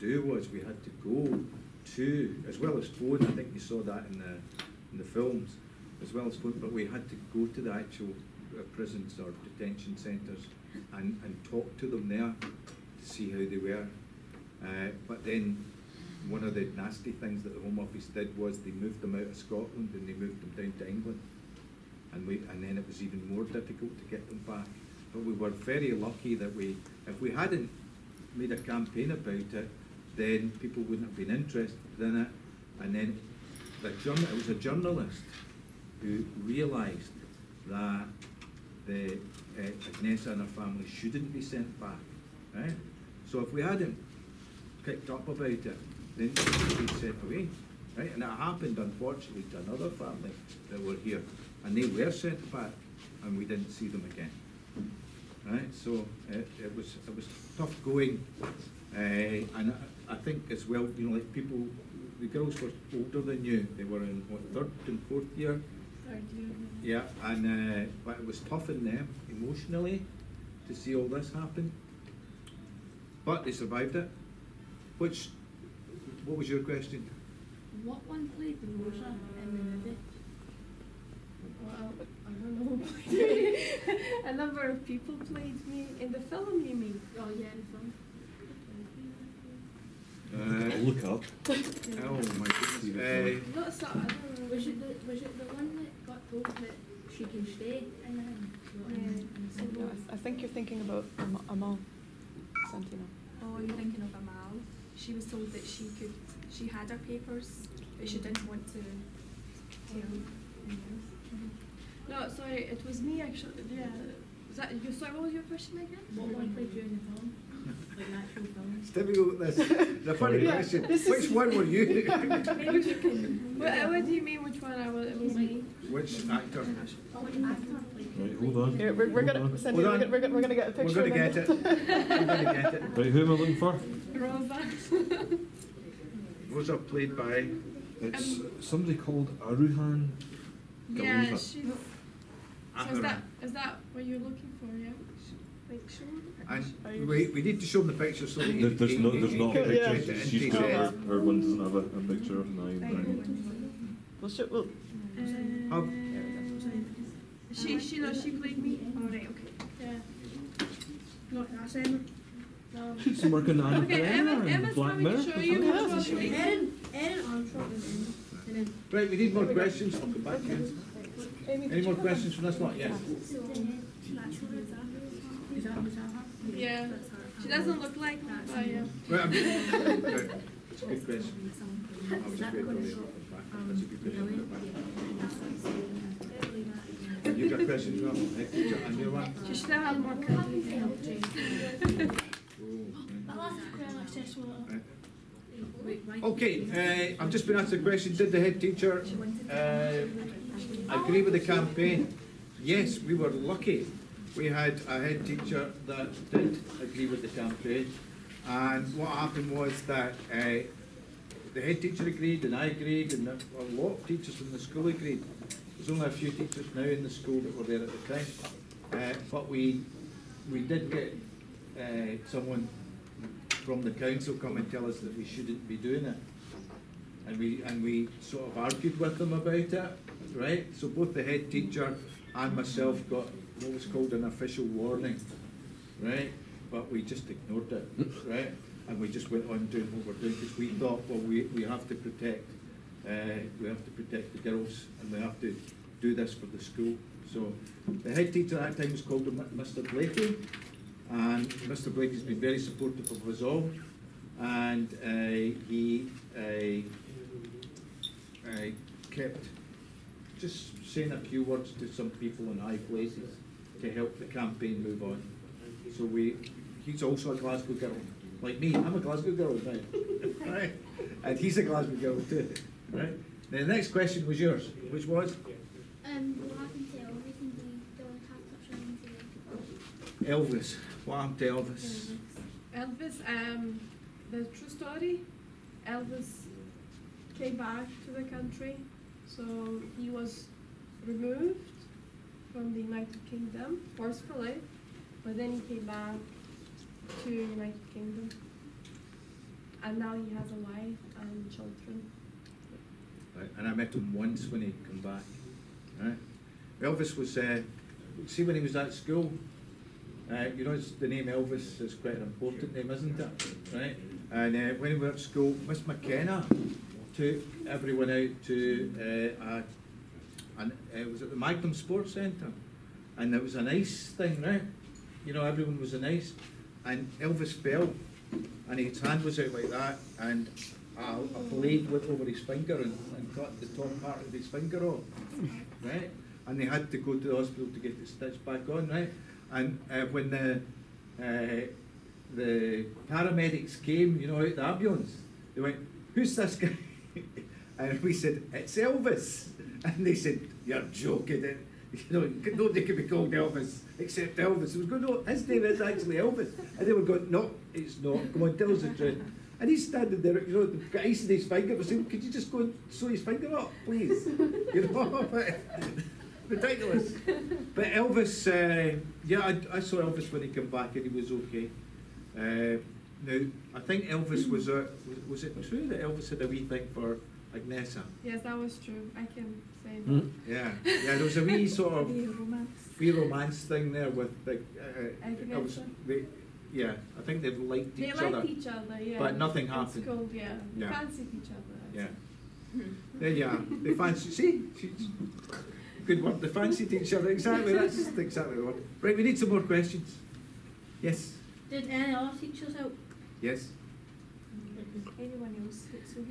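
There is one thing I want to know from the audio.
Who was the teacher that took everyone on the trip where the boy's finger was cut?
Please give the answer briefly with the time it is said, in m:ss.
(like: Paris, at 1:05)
Miss McKenna, at 5:15.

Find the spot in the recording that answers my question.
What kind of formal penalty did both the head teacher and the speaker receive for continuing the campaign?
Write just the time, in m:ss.
3:54.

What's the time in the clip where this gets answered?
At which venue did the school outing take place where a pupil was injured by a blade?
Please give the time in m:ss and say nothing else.
5:21.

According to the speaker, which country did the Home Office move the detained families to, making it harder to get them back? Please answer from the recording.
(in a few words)
England.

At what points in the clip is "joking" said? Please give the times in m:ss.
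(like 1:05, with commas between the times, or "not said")
5:50.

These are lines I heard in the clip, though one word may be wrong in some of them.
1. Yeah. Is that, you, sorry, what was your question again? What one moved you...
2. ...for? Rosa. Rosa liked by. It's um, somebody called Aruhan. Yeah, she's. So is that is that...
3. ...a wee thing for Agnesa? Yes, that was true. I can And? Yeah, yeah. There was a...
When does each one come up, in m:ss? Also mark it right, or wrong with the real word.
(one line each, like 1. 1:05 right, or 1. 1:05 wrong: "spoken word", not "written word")
1. 1:53 wrong: "played", not "moved"
2. 2:13 wrong: "played", not "liked"
3. 6:16 wrong: "Hmm", not "And".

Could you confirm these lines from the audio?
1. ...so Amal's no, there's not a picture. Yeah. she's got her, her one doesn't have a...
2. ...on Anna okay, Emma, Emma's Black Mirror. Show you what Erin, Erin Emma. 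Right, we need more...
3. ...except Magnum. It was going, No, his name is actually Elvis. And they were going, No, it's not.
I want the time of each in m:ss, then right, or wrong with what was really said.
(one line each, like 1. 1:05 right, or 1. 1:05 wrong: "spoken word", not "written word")
1. 2:28 wrong: "There", not "Amal"
2. 2:43 right
3. 5:53 wrong: "Elvis", not "Magnum".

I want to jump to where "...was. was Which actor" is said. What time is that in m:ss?
2:04.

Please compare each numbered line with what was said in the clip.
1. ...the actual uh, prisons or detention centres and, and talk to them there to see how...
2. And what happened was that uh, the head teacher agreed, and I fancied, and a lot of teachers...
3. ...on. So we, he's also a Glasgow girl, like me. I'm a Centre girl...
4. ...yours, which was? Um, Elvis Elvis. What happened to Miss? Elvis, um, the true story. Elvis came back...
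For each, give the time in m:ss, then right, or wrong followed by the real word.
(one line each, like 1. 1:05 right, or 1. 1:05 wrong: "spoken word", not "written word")
1. 0:07 right
2. 3:28 wrong: "agreed", not "fancied"
3. 4:25 wrong: "Glasgow", not "Centre"
4. 4:34 wrong: "Elvis", not "Miss".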